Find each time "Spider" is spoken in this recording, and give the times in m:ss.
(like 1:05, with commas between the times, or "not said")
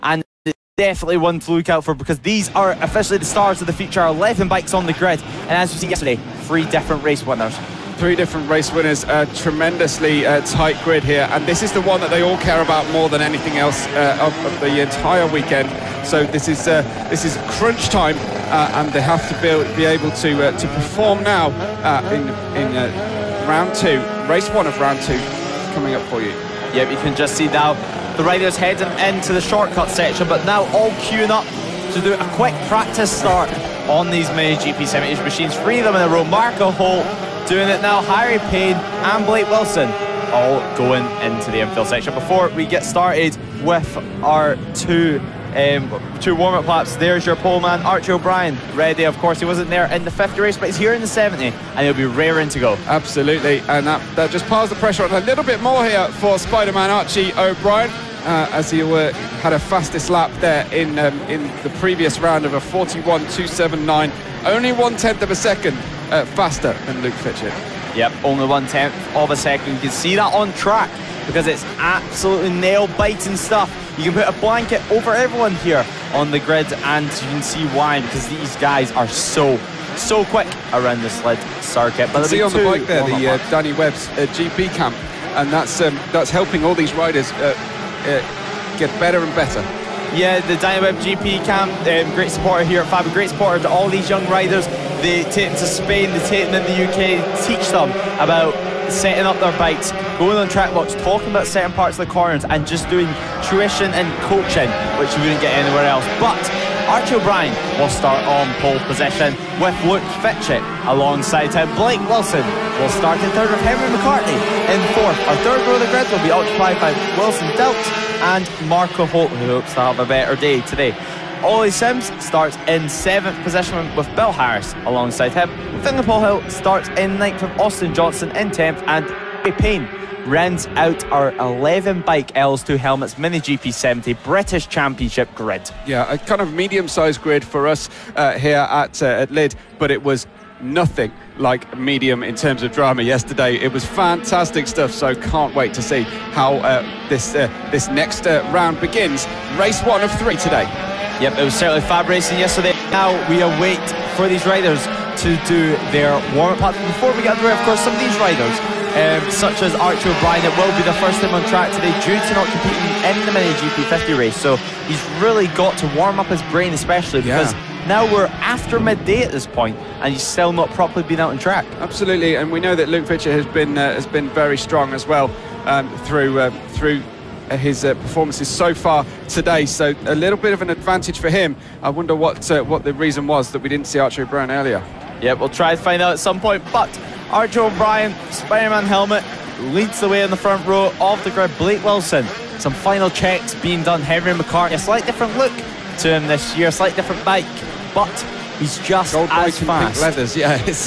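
0:56, 3:08.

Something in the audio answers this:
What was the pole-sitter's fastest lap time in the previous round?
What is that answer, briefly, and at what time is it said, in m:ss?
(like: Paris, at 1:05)
41.279, at 1:02.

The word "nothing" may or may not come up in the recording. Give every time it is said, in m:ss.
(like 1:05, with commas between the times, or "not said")
2:20.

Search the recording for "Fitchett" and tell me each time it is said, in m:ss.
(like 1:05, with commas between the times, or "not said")
1:07, 1:50, 2:53.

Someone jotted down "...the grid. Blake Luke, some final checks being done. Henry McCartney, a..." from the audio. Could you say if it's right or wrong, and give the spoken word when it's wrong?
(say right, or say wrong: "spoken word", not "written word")
wrong: "Wilson", not "Luke".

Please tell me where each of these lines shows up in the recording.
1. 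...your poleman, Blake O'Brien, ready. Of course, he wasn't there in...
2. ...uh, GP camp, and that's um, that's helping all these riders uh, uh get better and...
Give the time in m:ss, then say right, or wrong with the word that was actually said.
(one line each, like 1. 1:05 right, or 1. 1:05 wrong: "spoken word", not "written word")
1. 0:47 wrong: "Archie", not "Blake"
2. 1:24 right.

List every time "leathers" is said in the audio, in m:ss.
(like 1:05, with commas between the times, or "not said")
3:20.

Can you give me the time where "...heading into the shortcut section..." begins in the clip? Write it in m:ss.
0:28.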